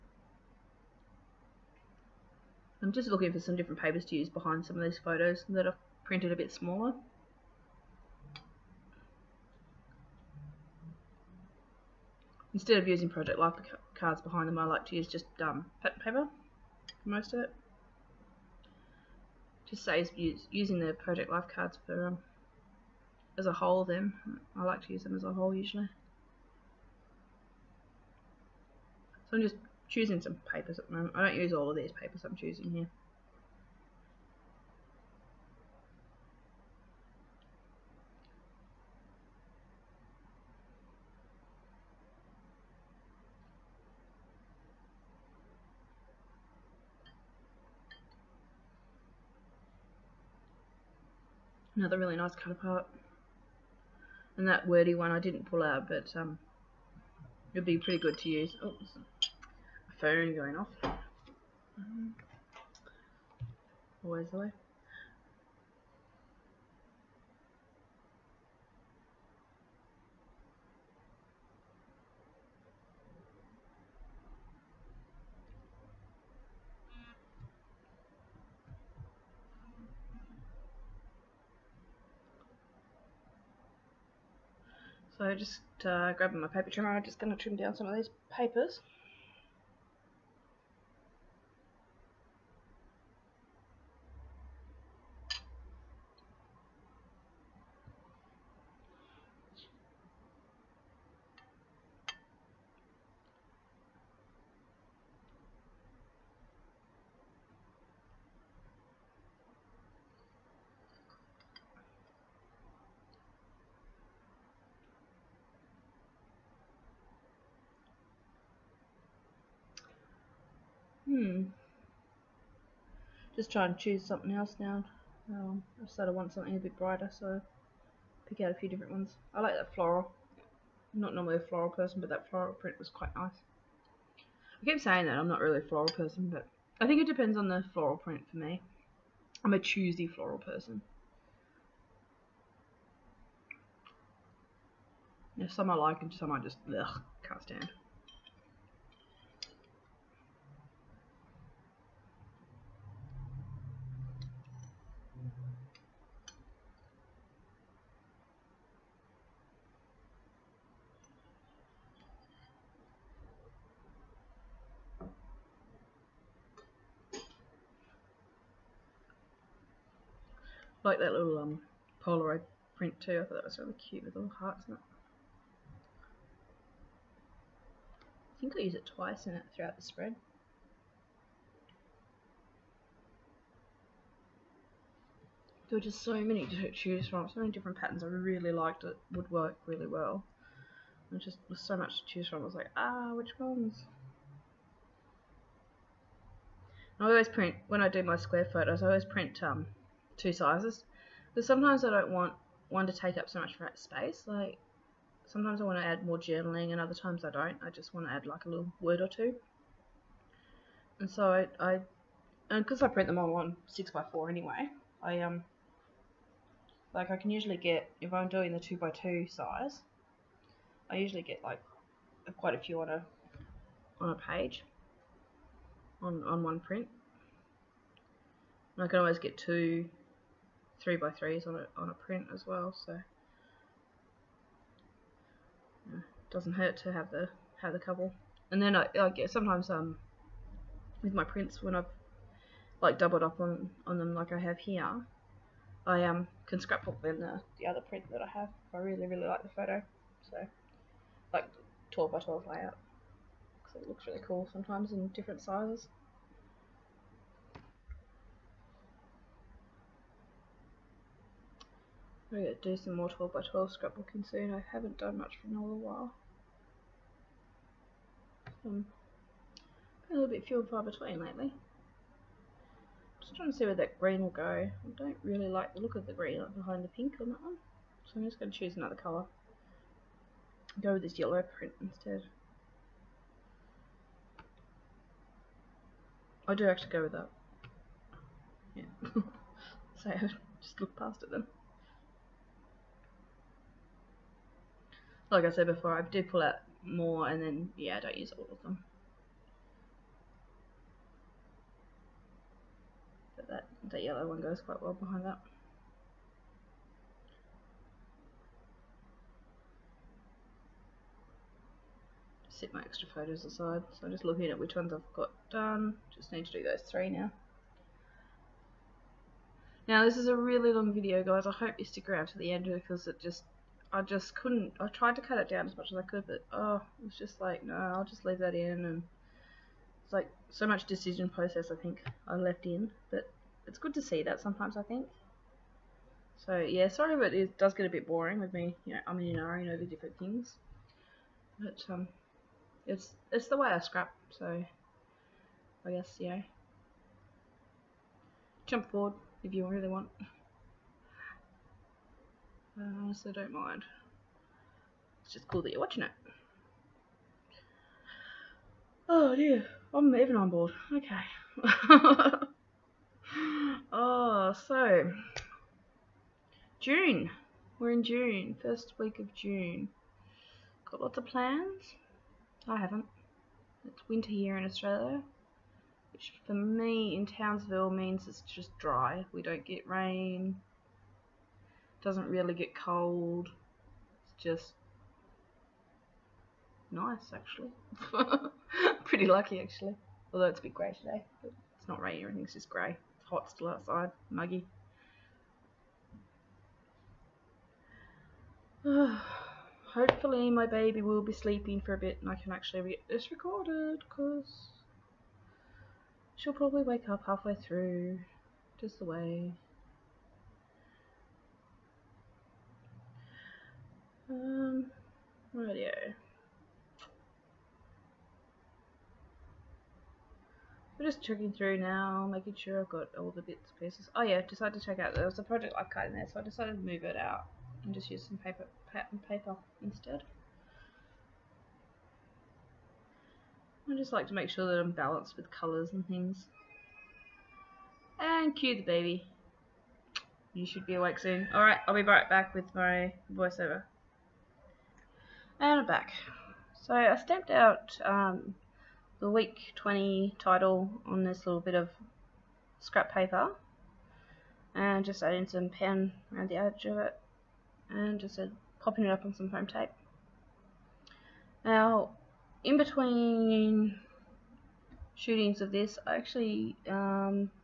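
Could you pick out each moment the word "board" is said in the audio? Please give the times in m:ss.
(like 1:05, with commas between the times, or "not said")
6:00.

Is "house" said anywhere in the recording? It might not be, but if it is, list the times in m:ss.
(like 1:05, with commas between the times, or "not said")
not said.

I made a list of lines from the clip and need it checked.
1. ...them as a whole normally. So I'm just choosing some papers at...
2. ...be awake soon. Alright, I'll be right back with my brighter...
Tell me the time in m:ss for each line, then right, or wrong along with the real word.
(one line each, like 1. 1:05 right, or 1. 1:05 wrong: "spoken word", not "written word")
1. 0:25 wrong: "usually", not "normally"
2. 7:20 wrong: "voiceover", not "brighter".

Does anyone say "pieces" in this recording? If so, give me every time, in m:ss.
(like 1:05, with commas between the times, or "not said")
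7:03.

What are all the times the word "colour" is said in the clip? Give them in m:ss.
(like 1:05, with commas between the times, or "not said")
4:38, 7:15.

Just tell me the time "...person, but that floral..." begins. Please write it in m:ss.
2:11.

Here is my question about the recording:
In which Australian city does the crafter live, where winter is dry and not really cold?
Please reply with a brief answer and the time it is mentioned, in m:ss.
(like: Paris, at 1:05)
Townsville, at 6:17.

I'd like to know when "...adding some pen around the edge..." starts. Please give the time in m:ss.
7:35.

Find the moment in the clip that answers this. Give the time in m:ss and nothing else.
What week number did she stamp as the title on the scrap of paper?
7:29.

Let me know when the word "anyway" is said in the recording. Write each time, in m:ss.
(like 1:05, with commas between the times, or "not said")
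3:34.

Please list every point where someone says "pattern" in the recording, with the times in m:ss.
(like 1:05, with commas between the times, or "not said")
0:15, 3:07, 7:08.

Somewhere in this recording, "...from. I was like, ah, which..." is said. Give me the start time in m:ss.
3:12.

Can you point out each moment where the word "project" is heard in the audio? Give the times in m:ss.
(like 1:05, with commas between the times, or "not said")
0:13, 0:20, 7:05.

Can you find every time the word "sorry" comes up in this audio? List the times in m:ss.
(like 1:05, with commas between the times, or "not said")
5:36.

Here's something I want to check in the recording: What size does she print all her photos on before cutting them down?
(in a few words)
6 by 4.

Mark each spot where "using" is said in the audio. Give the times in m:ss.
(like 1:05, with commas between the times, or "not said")
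0:12, 0:20.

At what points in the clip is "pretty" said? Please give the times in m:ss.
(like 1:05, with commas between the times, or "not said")
0:57, 6:29.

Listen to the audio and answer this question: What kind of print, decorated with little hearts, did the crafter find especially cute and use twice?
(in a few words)
Polaroid print.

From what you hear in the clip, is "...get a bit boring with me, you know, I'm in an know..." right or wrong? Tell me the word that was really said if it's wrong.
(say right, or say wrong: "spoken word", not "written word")
right.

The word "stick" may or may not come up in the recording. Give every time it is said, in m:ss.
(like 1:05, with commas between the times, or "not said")
5:21.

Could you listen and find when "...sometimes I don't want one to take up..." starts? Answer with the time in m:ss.
3:21.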